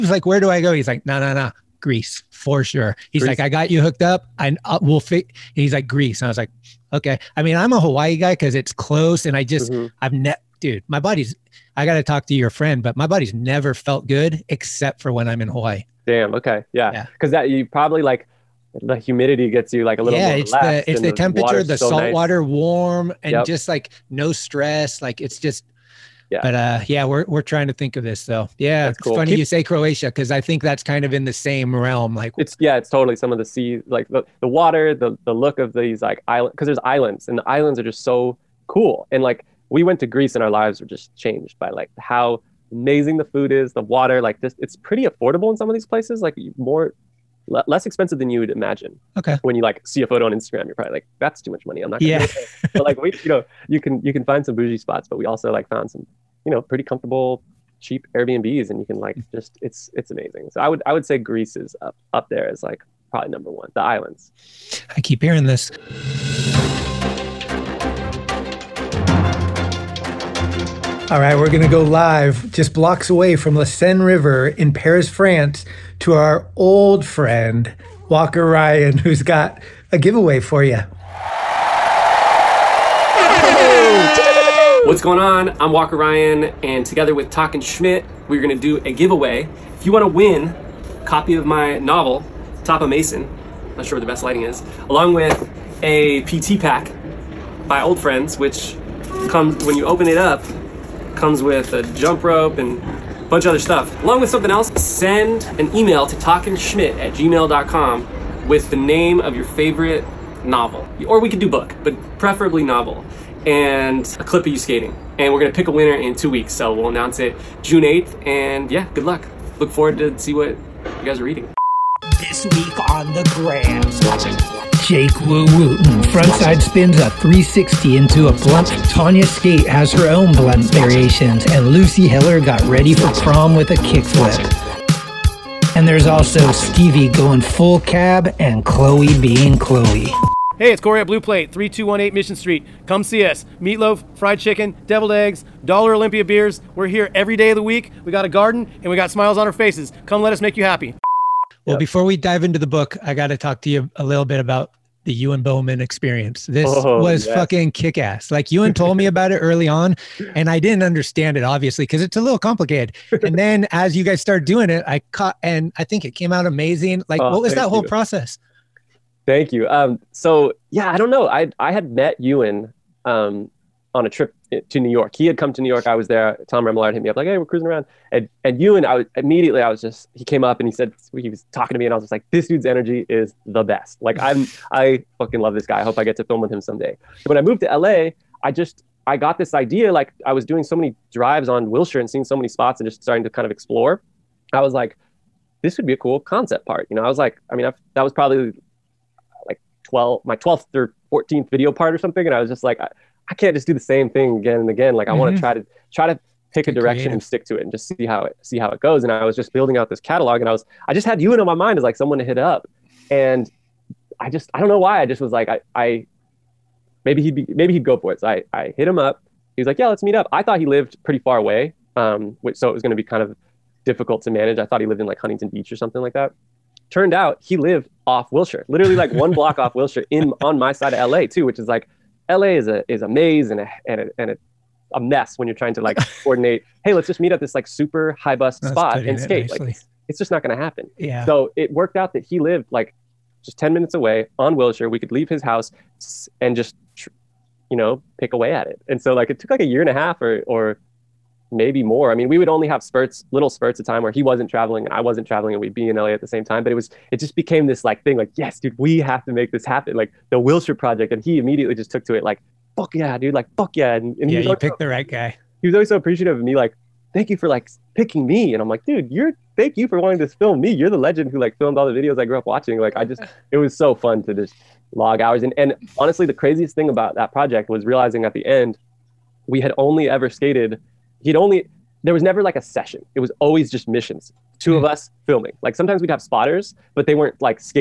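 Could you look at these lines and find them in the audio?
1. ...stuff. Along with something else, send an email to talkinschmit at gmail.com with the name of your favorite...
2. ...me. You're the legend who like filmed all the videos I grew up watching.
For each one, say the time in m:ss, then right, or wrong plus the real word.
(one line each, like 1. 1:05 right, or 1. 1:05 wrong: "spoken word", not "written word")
1. 1:43 right
2. 4:30 right.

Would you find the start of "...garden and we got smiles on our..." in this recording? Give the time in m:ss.
2:28.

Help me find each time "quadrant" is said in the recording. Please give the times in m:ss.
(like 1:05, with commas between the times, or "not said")
not said.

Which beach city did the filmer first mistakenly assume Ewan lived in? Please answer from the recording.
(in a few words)
Huntington Beach.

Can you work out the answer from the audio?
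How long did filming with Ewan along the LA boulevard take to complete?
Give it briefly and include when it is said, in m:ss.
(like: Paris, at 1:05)
a year and a half, at 4:09.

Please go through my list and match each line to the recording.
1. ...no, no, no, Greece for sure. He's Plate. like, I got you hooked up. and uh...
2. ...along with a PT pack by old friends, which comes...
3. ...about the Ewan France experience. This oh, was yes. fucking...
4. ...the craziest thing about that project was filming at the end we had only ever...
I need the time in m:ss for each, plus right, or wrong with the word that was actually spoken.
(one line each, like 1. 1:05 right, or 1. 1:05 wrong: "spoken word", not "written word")
1. 0:01 wrong: "Greece", not "Plate"
2. 1:34 right
3. 2:34 wrong: "Bowman", not "France"
4. 4:36 wrong: "realizing", not "filming".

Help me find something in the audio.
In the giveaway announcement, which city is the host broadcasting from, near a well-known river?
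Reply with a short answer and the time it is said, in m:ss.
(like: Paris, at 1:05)
Paris, at 1:14.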